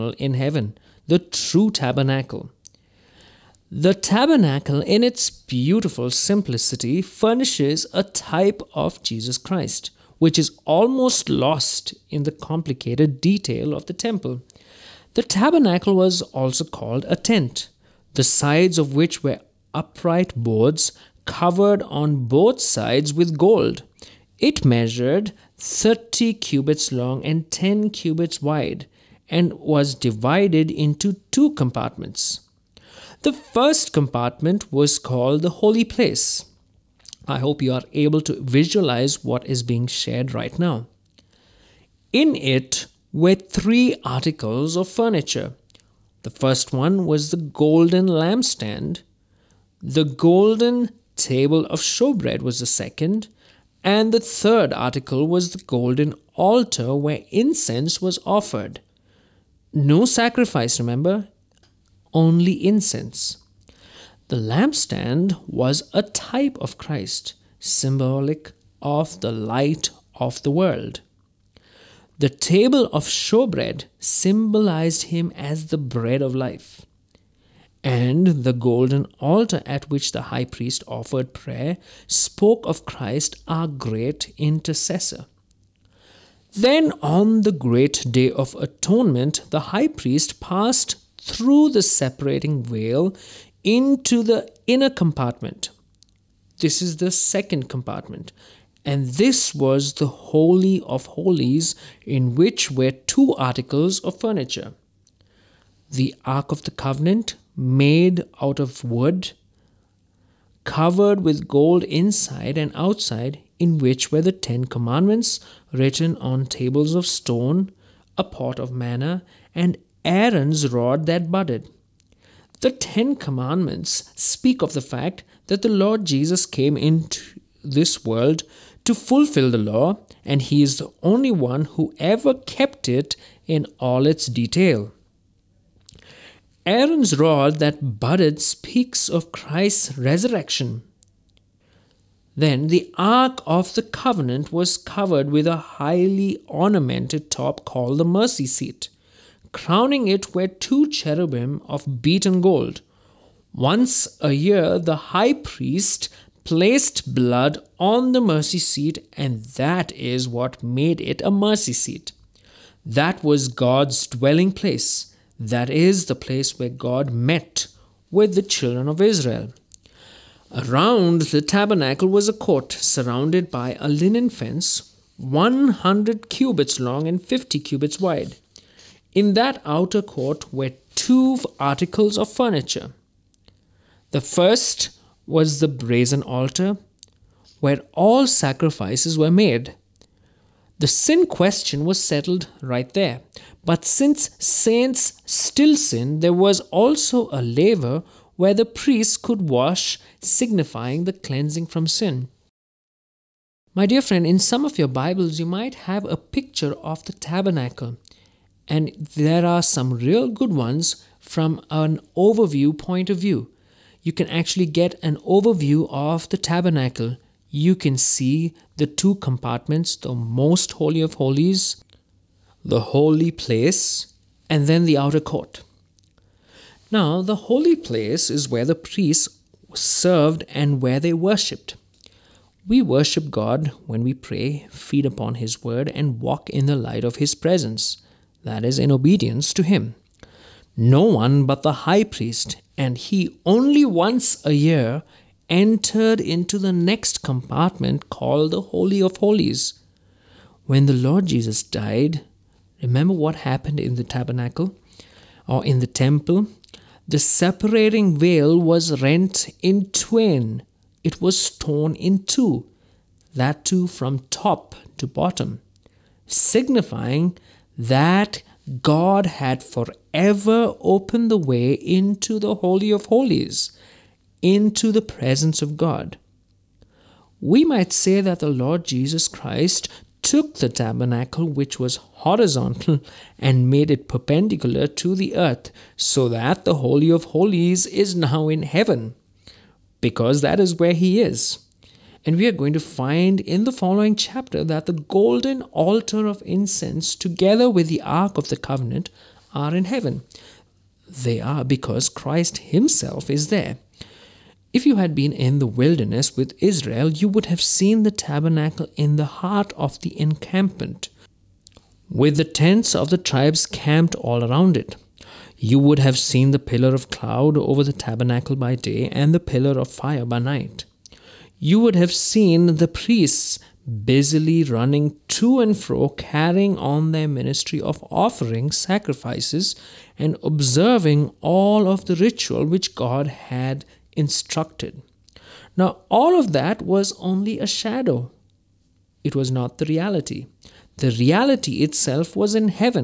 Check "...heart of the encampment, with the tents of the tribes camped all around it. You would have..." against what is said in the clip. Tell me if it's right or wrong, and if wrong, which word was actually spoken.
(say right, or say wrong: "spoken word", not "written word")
right.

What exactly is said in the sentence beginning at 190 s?
The sin question was settled right there.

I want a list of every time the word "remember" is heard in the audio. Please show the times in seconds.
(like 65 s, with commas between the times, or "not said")
60 s, 252 s.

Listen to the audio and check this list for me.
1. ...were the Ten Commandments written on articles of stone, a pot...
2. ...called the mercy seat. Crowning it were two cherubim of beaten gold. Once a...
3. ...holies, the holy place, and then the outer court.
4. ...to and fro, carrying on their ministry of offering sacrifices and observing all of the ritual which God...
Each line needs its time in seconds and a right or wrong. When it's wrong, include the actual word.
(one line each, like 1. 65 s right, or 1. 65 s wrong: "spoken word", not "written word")
1. 114 s wrong: "tables", not "articles"
2. 147 s right
3. 221 s right
4. 325 s right.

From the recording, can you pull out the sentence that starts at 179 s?
In that outer court were two articles of furniture.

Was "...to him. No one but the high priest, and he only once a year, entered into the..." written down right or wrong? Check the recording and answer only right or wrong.
right.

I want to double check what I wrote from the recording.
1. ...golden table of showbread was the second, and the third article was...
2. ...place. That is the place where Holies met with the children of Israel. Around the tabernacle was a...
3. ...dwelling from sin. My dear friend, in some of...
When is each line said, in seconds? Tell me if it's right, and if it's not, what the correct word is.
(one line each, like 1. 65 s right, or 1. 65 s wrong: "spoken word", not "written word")
1. 50 s right
2. 164 s wrong: "God", not "Holies"
3. 201 s wrong: "cleansing", not "dwelling".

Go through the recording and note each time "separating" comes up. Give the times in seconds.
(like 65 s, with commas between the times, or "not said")
91 s, 257 s.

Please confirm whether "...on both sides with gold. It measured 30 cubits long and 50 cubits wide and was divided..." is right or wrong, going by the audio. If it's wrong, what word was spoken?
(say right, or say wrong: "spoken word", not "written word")
wrong: "10", not "50".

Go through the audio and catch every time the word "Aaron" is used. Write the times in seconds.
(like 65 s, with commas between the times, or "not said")
120 s, 136 s.